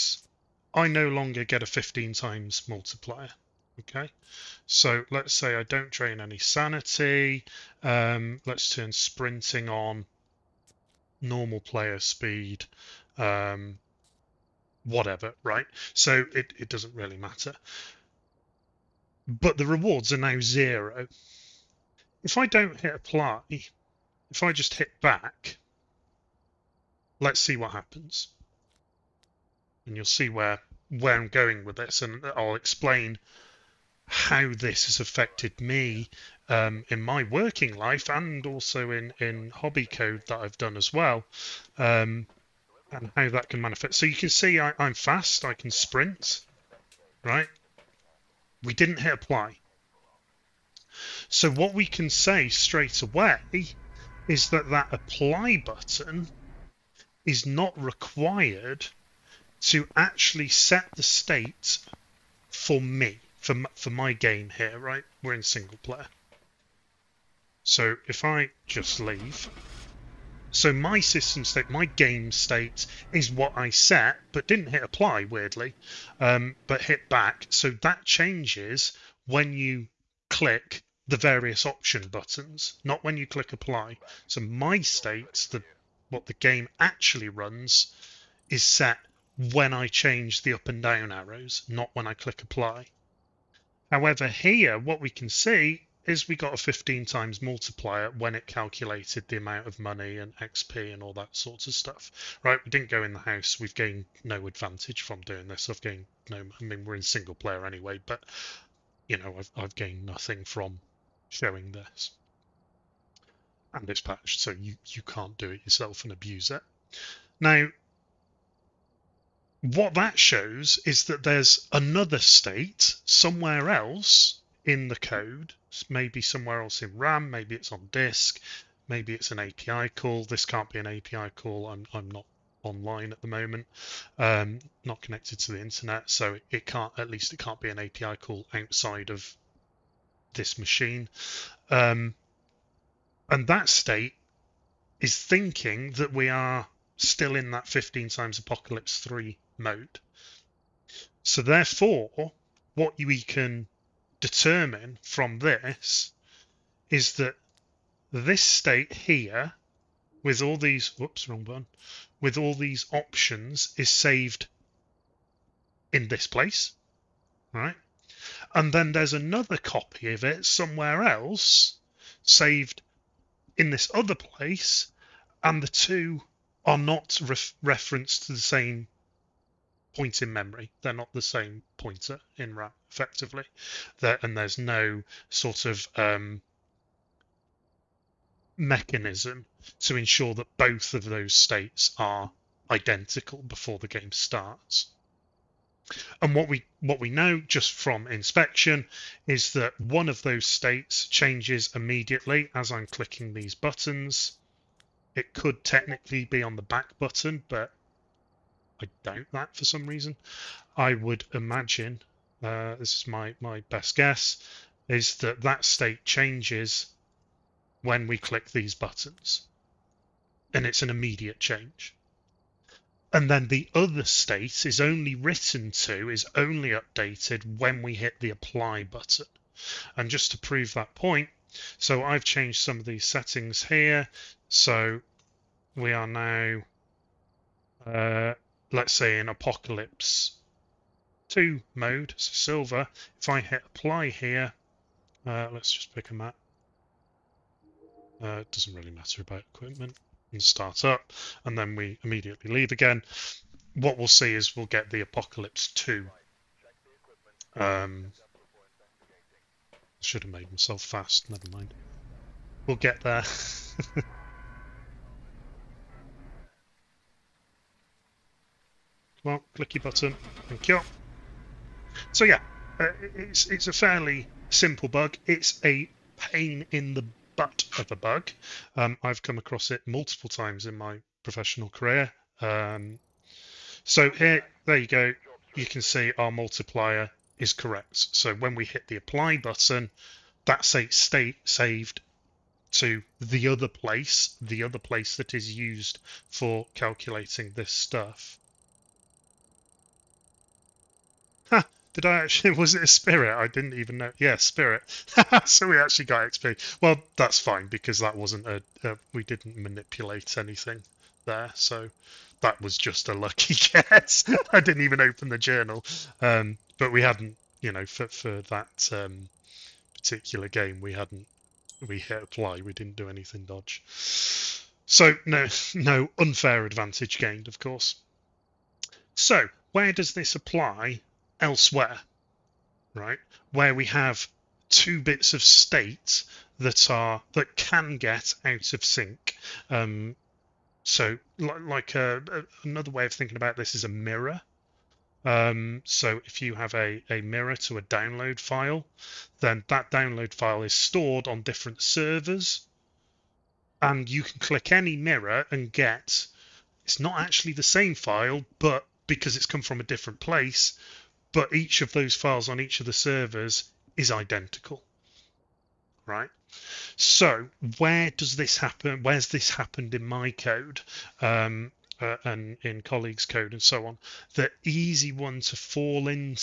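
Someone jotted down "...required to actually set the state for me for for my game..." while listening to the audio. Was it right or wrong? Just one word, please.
right.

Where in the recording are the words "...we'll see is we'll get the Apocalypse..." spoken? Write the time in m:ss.
4:13.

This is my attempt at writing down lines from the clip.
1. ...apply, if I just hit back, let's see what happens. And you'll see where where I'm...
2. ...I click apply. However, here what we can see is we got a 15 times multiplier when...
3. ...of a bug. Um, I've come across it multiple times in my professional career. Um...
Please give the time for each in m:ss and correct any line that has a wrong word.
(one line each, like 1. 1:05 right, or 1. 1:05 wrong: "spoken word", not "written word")
1. 0:22 right
2. 1:32 right
3. 4:37 right.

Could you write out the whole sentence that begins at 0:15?
So it, it doesn't really matter.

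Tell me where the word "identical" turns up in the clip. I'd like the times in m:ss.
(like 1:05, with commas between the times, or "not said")
3:12, 6:04.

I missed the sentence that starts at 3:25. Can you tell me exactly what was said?
It could technically be on the back button, but I doubt that for some reason.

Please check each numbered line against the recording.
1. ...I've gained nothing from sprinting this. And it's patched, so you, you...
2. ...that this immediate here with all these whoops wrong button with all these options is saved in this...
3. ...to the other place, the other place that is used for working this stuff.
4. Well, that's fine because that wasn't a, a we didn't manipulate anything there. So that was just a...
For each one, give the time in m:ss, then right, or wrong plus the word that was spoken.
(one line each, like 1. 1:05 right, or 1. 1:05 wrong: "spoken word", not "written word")
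1. 1:49 wrong: "showing", not "sprinting"
2. 2:37 wrong: "state", not "immediate"
3. 4:52 wrong: "calculating", not "working"
4. 5:06 right.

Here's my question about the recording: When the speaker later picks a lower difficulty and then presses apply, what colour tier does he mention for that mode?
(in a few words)
silver.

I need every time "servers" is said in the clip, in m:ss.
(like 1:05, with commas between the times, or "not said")
5:51, 6:02.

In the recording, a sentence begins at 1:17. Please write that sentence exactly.
So that changes when you click the various option buttons, not when you click apply.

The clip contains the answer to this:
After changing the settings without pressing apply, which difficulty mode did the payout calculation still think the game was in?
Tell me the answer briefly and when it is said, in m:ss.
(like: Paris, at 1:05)
Apocalypse 3, at 2:28.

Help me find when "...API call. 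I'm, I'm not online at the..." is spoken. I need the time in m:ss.
2:10.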